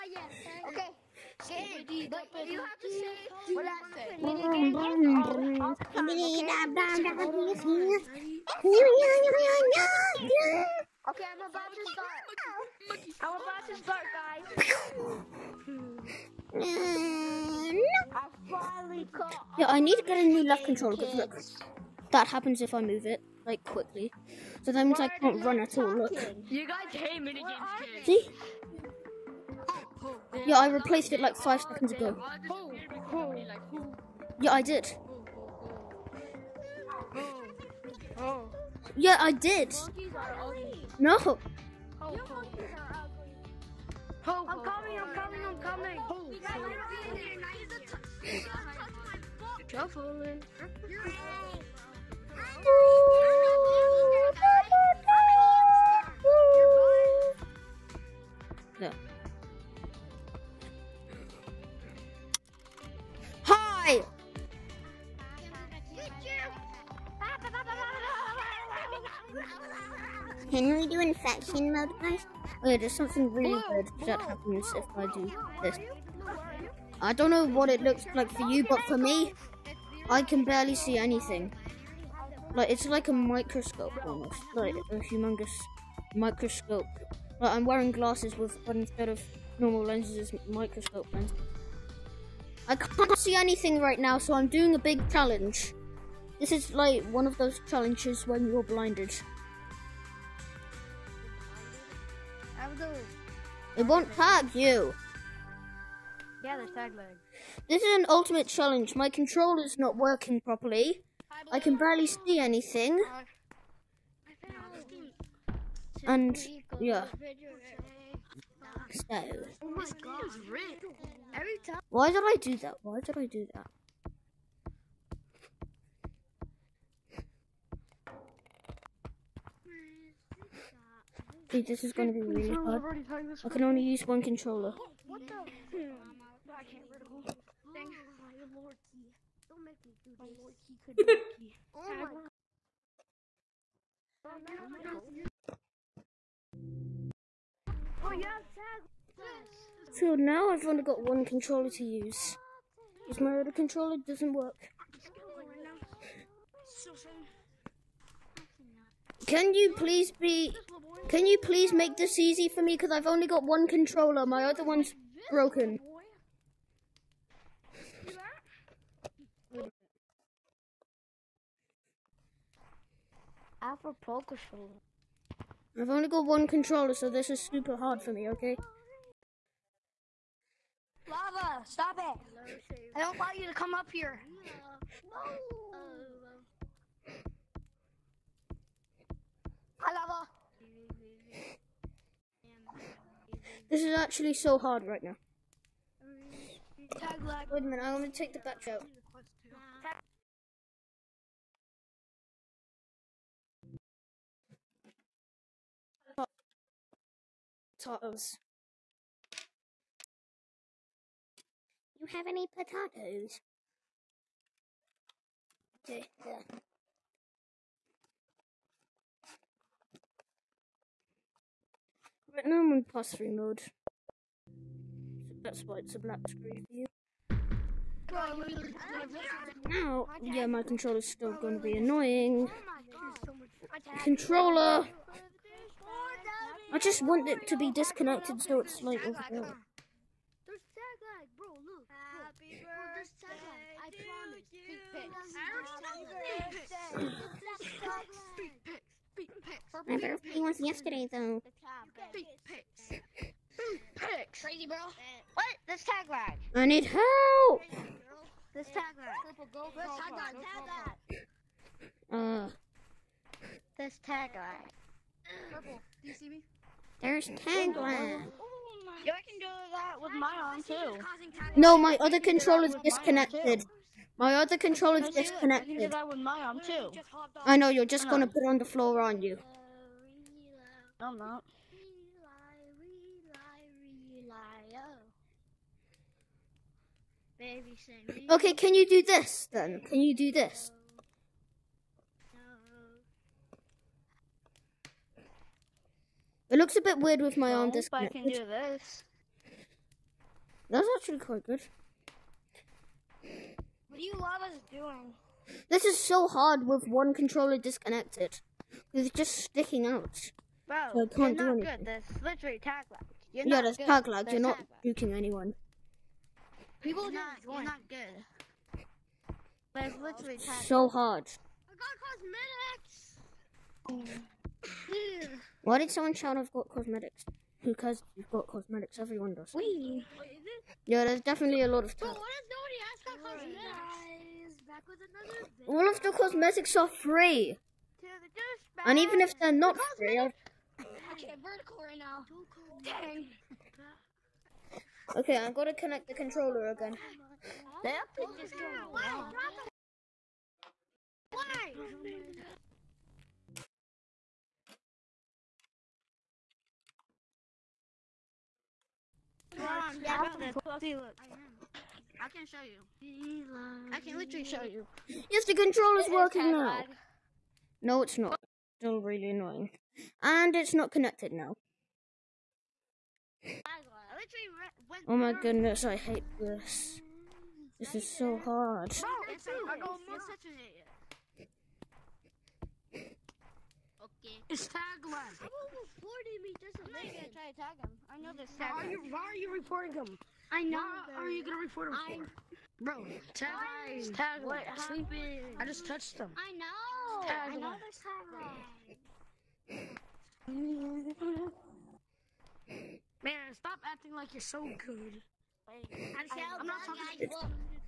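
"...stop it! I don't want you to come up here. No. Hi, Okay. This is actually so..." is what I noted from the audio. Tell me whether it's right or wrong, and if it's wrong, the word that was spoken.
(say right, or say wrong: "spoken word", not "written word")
wrong: "Lava", not "Okay".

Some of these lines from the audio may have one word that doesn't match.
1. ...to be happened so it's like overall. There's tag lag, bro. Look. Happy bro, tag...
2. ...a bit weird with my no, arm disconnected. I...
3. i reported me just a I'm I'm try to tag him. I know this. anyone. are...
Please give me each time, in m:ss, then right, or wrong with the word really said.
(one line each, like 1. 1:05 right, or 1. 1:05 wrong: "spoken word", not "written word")
1. 3:57 wrong: "disconnected", not "happened"
2. 4:56 right
3. 6:25 wrong: "tagline", not "anyone".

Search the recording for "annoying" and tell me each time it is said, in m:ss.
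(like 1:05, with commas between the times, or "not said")
3:51, 6:09.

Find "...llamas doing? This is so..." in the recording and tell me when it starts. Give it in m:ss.
5:04.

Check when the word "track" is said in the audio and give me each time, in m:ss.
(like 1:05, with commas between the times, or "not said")
not said.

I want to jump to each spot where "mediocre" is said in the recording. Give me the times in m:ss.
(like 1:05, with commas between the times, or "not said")
not said.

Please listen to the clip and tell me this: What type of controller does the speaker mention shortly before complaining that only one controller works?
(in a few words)
A Pro controller.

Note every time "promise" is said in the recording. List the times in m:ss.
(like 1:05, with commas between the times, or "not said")
4:06.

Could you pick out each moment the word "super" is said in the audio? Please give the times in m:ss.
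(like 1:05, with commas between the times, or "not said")
2:57.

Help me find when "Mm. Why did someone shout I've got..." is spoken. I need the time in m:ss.
5:23.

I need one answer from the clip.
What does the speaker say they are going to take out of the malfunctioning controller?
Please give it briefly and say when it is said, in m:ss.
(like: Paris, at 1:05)
The battery, at 3:18.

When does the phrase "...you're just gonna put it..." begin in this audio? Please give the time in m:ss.
4:37.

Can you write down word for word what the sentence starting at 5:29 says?
Wait, yeah, there's definitely a lot of stuff.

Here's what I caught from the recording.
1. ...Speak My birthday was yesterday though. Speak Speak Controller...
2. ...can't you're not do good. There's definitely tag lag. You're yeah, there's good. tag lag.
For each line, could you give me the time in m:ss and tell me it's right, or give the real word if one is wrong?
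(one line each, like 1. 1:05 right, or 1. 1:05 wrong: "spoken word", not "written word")
1. 4:09 wrong: "Crazy", not "Controller"
2. 5:11 wrong: "literally", not "definitely".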